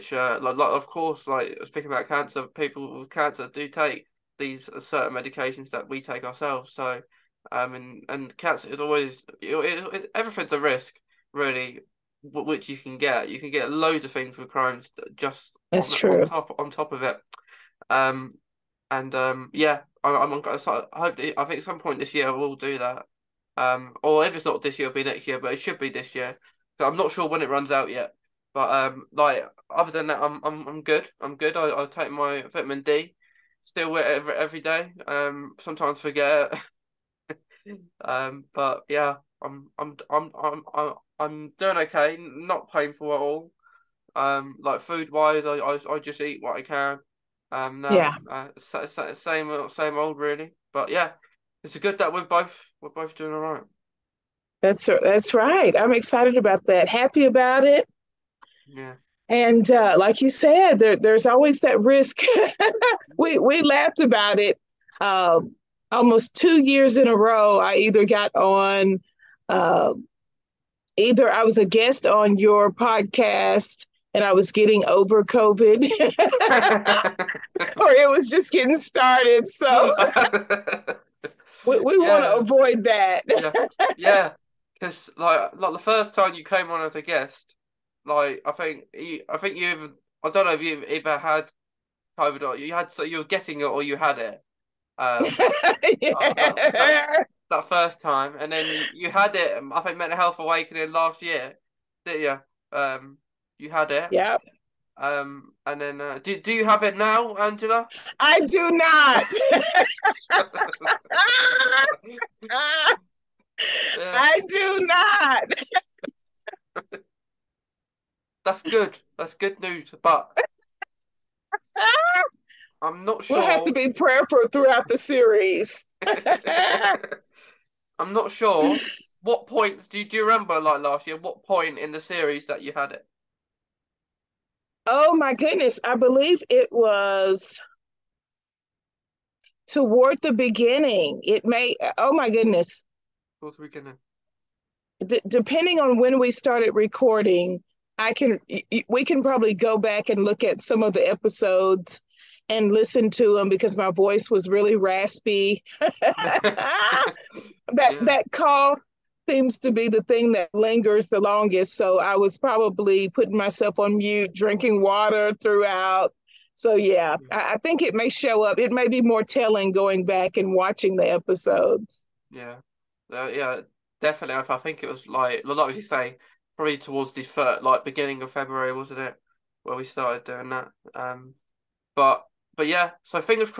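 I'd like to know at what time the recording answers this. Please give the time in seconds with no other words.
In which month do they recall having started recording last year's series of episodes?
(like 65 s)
178 s.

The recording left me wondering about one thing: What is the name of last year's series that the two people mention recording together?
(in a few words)
Mental Health Awakening.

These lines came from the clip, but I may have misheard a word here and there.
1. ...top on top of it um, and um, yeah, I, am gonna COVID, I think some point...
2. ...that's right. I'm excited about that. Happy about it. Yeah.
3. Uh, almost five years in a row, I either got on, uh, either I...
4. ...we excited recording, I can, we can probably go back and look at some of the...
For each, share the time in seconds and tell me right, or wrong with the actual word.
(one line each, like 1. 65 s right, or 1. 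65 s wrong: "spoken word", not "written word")
1. 16 s wrong: "Hopefully", not "COVID"
2. 55 s right
3. 64 s wrong: "two", not "five"
4. 146 s wrong: "started", not "excited".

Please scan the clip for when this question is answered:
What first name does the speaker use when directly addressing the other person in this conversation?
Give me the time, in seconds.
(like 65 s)
107 s.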